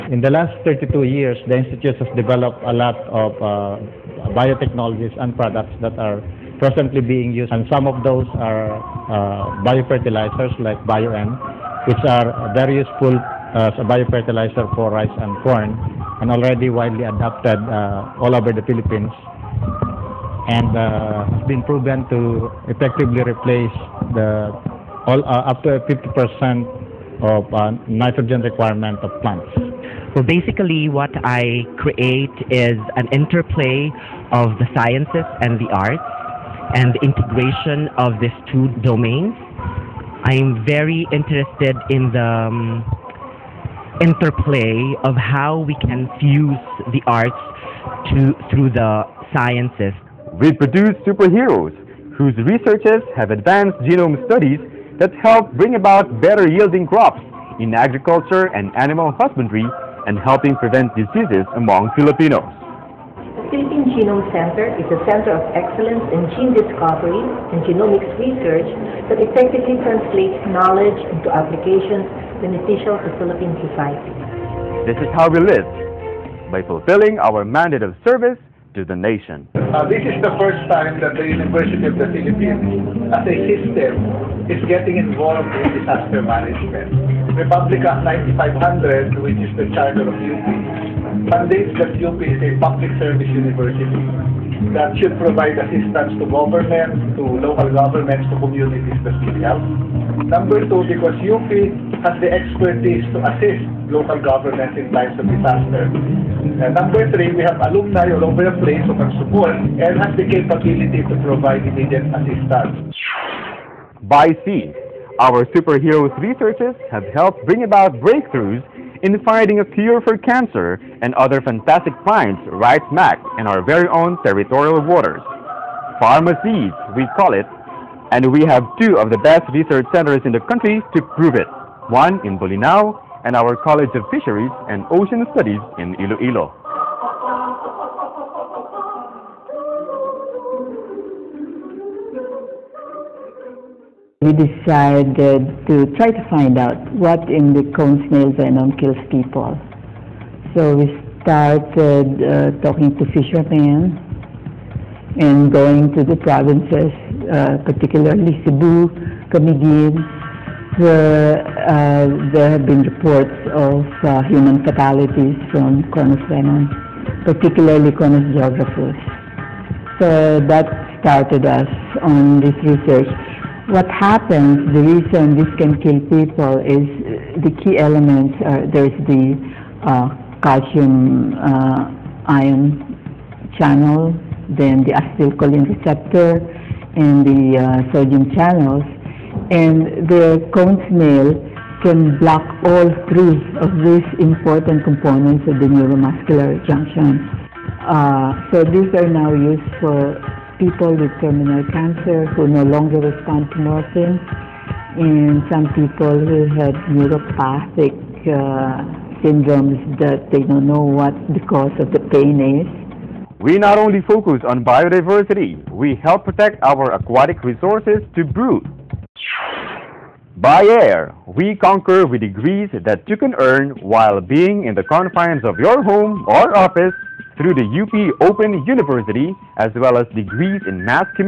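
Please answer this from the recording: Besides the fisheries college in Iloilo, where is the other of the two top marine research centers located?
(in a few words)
Bolinao.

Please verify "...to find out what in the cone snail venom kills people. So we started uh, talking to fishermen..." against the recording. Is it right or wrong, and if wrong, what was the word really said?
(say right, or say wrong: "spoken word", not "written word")
right.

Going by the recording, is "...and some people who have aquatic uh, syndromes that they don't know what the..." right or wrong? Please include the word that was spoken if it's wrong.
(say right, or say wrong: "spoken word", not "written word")
wrong: "neuropathic", not "aquatic".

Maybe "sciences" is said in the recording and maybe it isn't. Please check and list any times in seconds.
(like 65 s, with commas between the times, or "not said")
34 s, 49 s.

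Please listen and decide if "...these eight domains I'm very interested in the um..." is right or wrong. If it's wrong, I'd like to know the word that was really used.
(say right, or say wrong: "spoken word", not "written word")
wrong: "two", not "eight".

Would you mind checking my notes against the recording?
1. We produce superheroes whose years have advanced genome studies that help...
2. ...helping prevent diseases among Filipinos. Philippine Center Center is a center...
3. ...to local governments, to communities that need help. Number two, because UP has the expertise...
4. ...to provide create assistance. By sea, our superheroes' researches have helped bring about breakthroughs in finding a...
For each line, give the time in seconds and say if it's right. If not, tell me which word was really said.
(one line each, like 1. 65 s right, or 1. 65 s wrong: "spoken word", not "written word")
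1. 50 s wrong: "researchers", not "years"
2. 60 s wrong: "Genome", not "Center"
3. 97 s right
4. 111 s wrong: "immediate", not "create".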